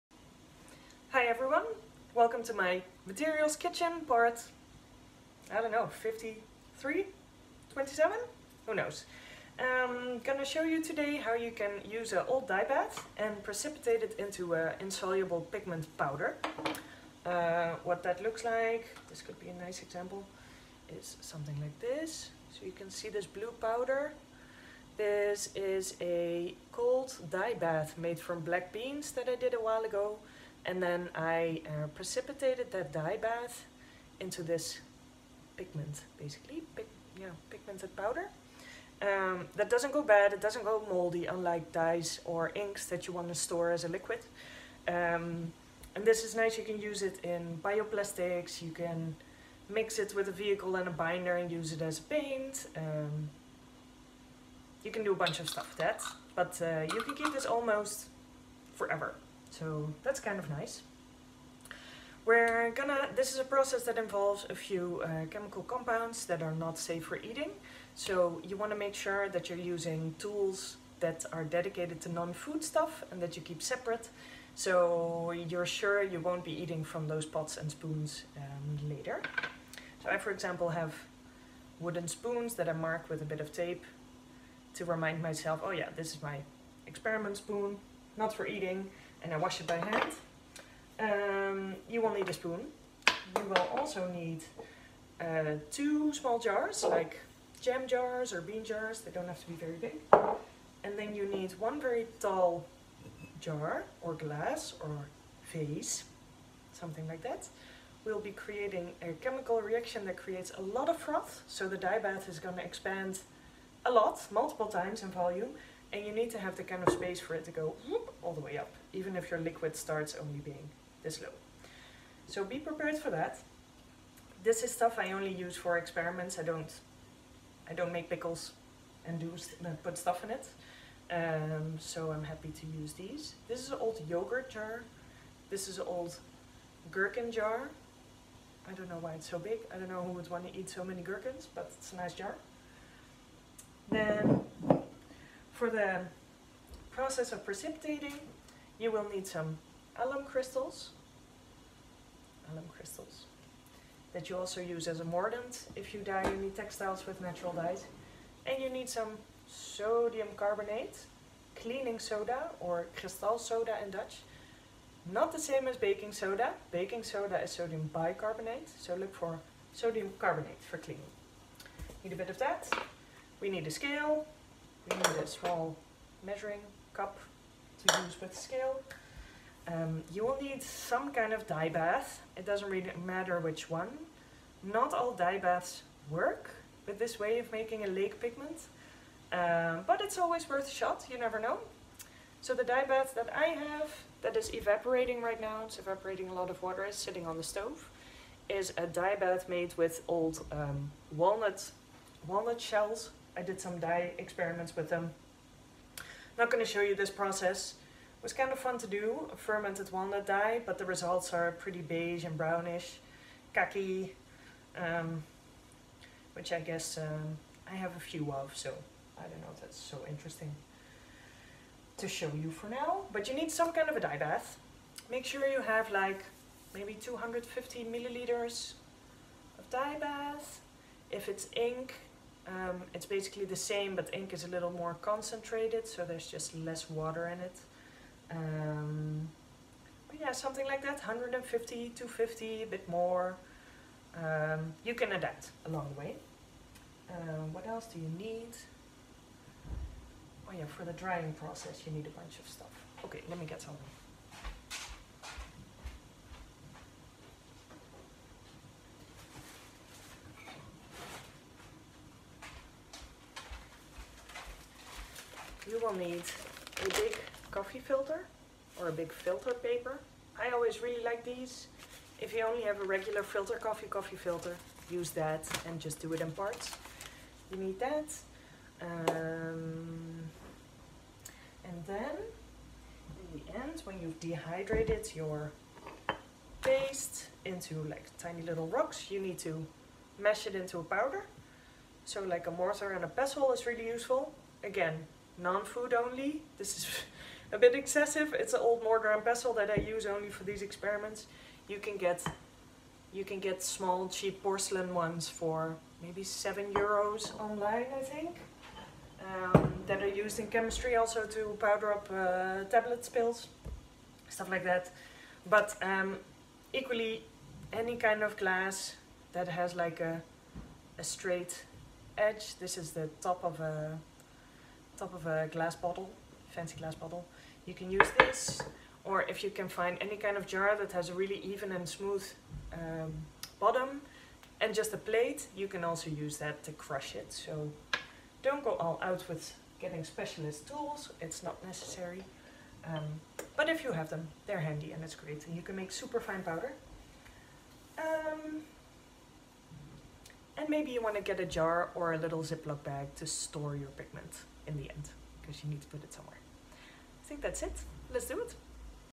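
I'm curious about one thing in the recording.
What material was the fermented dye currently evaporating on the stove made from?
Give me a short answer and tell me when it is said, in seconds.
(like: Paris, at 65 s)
Walnut shells, at 202 s.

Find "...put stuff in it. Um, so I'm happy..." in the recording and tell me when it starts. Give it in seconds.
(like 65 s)
129 s.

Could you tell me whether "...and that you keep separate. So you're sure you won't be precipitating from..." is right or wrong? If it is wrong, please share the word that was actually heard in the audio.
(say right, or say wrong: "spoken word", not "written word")
wrong: "eating", not "precipitating".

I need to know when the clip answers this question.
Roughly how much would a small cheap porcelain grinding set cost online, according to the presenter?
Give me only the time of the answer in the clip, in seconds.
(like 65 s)
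306 s.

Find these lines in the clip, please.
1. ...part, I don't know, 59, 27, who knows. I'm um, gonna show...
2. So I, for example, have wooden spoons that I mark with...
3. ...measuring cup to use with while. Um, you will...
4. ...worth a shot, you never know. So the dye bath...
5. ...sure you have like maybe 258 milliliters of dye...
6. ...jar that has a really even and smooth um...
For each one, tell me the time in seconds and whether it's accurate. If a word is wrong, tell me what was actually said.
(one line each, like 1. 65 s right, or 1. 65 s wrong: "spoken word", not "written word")
1. 4 s wrong: "53", not "59"
2. 80 s right
3. 176 s wrong: "scale", not "while"
4. 190 s right
5. 225 s wrong: "250", not "258"
6. 330 s right.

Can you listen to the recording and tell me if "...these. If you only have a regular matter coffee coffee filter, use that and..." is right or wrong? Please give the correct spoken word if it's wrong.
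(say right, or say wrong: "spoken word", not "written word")
wrong: "filter", not "matter".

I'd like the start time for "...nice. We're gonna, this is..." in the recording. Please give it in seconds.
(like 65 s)
60 s.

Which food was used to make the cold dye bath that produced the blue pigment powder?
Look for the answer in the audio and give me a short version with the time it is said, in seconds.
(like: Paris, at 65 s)
Black beans, at 28 s.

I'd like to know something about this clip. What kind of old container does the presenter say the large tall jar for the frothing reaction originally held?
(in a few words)
Gherkins.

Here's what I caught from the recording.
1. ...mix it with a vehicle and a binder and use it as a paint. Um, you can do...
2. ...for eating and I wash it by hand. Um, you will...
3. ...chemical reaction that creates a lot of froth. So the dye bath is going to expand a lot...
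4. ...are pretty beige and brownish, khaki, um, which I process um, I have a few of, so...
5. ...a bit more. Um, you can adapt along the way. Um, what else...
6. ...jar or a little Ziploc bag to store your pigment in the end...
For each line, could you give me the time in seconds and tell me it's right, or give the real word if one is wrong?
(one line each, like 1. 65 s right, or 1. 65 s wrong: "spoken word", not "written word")
1. 49 s right
2. 88 s right
3. 109 s right
4. 211 s wrong: "guess", not "process"
5. 242 s right
6. 351 s right.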